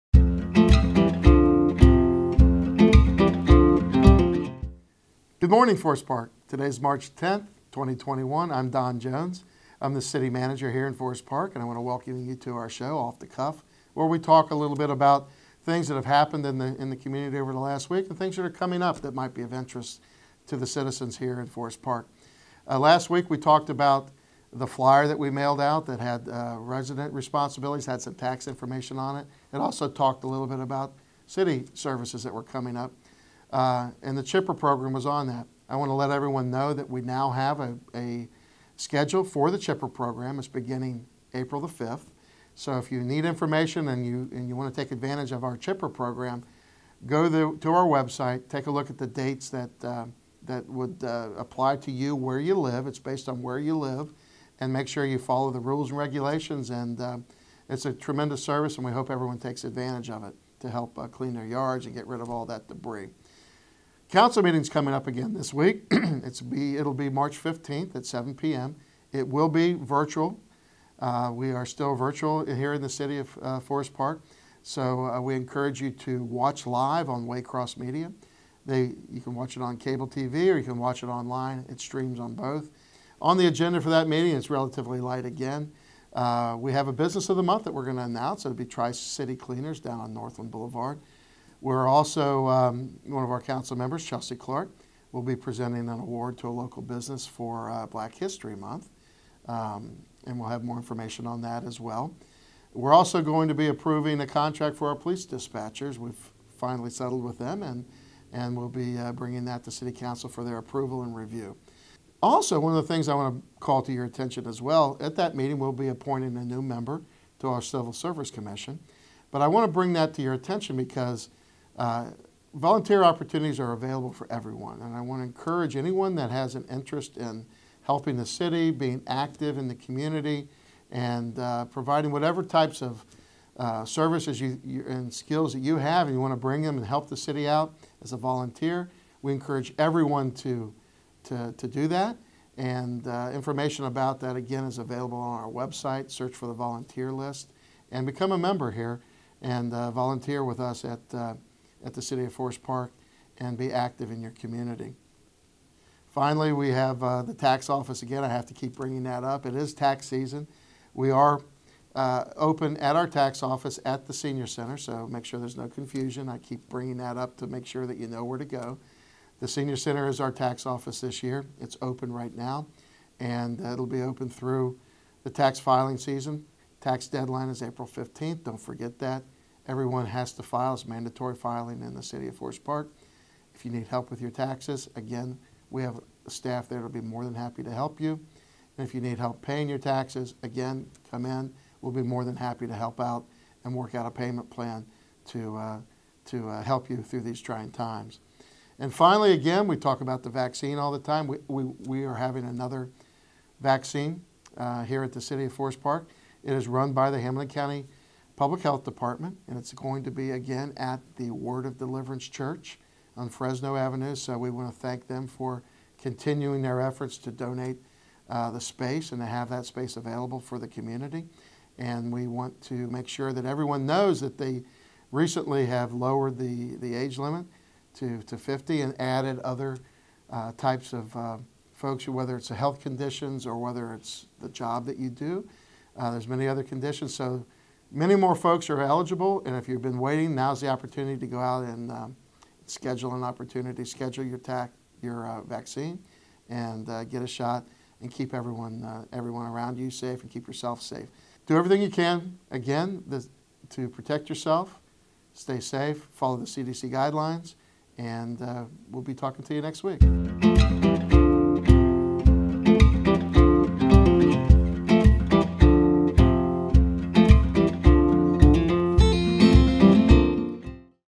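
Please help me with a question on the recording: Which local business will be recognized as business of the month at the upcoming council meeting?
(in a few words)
Tri City Cleaners.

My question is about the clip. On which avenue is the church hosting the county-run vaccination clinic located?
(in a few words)
Fresno Avenue.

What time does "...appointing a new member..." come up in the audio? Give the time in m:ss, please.
1:55.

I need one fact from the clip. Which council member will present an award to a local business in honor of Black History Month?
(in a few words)
Chelsea Clark.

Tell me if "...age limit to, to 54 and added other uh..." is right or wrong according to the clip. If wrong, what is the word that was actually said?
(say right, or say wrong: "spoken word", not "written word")
wrong: "50", not "54".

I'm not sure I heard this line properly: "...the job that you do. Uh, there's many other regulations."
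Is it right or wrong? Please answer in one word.
wrong.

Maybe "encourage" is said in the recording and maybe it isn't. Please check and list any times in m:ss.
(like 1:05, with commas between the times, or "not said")
1:15, 2:05, 2:19.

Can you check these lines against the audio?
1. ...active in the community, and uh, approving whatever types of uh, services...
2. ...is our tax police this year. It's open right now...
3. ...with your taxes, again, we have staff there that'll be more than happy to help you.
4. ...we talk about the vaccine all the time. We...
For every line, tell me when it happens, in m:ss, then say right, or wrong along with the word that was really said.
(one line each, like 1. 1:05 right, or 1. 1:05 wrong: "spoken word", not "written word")
1. 2:09 wrong: "providing", not "approving"
2. 2:50 wrong: "office", not "police"
3. 3:04 right
4. 3:19 right.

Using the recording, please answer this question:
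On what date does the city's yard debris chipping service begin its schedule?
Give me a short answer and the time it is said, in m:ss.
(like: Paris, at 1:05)
April 5th, at 0:41.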